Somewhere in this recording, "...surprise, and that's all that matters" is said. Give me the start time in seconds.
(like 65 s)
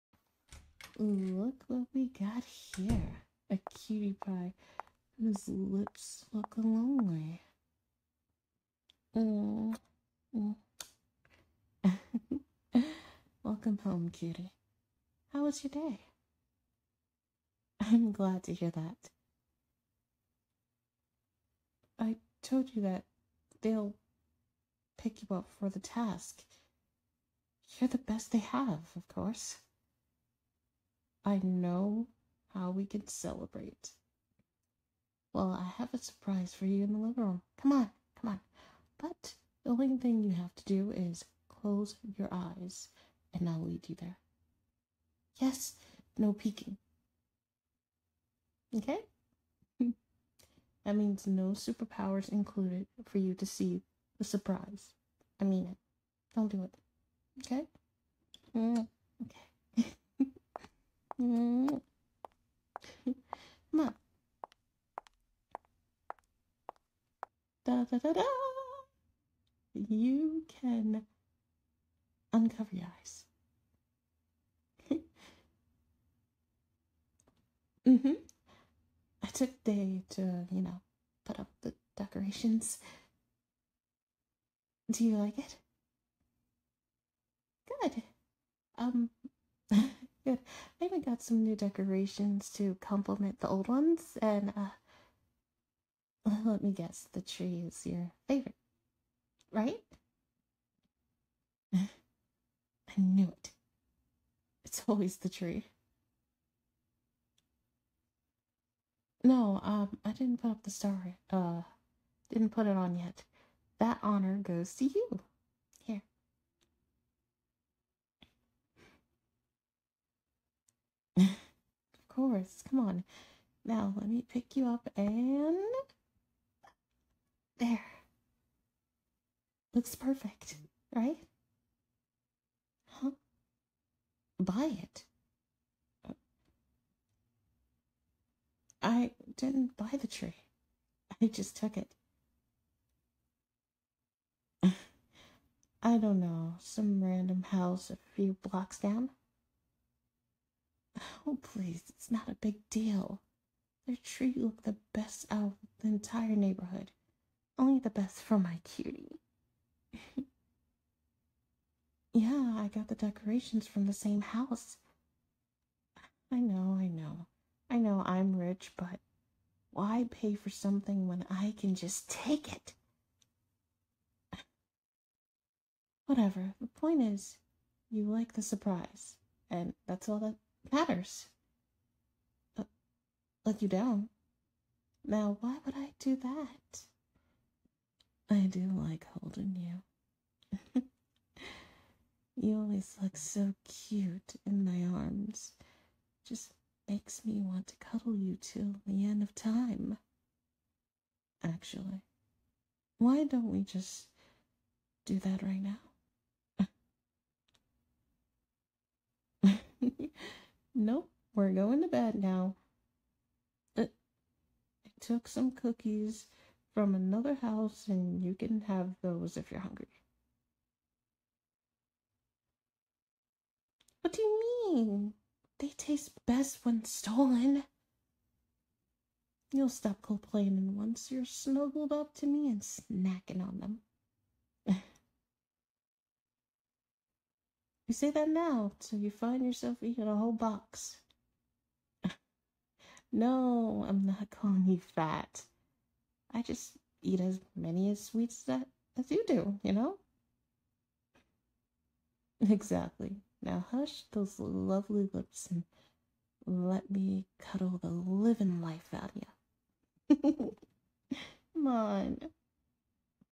178 s.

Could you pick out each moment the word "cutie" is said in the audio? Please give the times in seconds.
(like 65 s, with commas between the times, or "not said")
3 s, 14 s, 158 s.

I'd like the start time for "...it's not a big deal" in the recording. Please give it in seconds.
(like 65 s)
151 s.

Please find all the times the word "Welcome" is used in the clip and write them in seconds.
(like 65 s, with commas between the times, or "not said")
13 s.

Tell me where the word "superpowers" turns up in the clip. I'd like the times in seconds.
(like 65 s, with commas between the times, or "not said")
51 s.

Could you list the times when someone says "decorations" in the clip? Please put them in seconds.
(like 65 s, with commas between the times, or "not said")
81 s, 91 s, 162 s.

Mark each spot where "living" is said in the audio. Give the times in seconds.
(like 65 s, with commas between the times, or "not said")
36 s, 257 s.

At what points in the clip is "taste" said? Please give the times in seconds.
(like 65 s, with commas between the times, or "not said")
225 s.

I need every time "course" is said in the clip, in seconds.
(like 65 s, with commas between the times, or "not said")
29 s, 122 s.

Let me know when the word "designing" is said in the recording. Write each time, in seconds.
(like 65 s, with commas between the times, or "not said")
not said.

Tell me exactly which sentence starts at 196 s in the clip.
Just makes me want to cuddle you till the end of time.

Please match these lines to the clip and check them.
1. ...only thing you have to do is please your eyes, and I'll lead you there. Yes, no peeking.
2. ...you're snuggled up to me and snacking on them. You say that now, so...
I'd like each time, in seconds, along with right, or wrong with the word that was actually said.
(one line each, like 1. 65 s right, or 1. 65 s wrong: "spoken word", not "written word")
1. 39 s wrong: "close", not "please"
2. 231 s right.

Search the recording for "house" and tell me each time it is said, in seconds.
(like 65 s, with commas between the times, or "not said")
147 s, 164 s, 217 s.